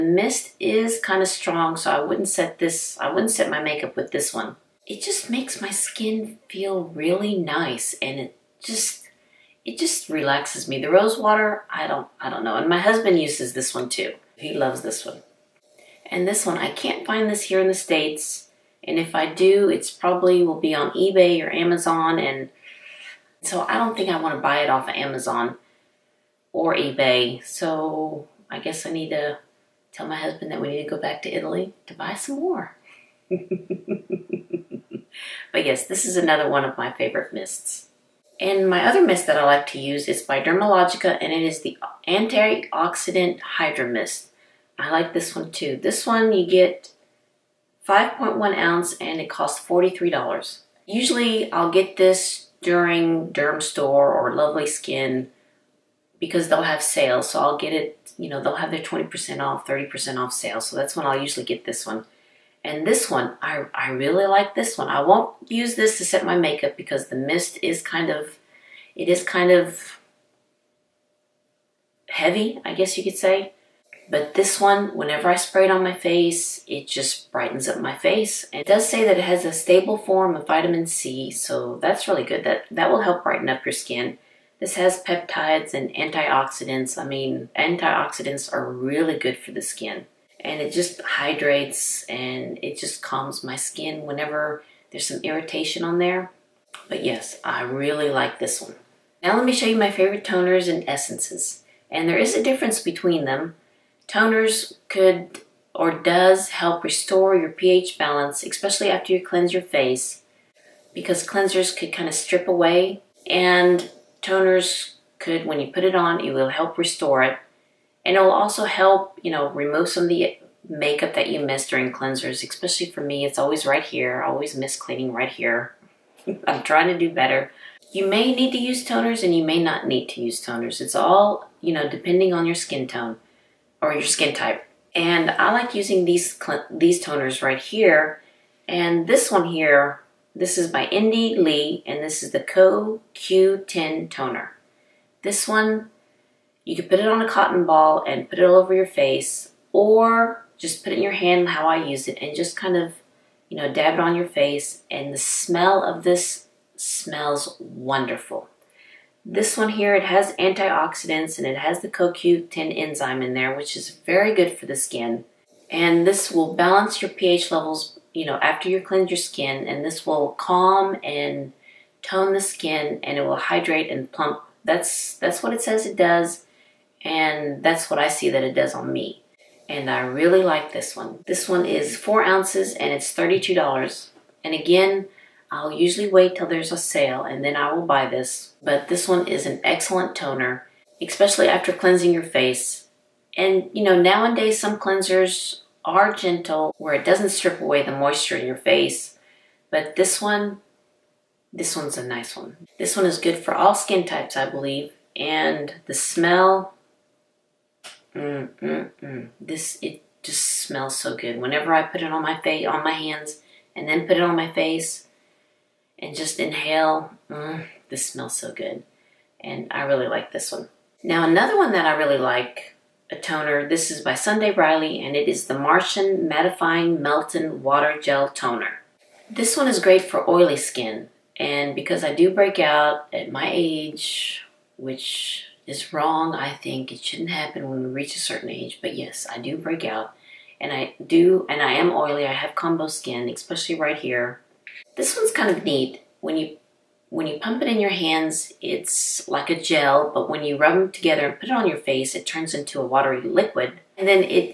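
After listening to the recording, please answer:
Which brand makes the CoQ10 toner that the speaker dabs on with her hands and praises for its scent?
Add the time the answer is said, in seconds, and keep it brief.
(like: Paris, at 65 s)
Indie Lee, at 140 s.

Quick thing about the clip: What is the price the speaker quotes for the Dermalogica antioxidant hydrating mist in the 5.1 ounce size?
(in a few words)
$43.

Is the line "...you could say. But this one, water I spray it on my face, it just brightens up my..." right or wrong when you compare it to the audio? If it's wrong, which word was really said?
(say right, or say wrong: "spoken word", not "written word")
wrong: "whenever", not "water".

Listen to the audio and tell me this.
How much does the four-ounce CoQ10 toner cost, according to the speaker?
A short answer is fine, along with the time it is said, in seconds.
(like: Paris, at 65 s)
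$32, at 183 s.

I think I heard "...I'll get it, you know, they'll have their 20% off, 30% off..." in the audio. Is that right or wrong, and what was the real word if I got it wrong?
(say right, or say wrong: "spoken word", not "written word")
right.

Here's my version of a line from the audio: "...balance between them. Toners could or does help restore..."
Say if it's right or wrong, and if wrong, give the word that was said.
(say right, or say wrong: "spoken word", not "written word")
wrong: "difference", not "balance".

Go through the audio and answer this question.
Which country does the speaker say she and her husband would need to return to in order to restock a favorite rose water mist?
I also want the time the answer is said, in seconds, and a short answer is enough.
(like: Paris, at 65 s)
Italy, at 31 s.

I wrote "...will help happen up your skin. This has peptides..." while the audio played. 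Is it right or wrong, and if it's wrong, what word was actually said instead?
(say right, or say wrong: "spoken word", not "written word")
wrong: "brighten", not "happen".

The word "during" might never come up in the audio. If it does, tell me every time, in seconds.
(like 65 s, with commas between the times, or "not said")
52 s, 121 s.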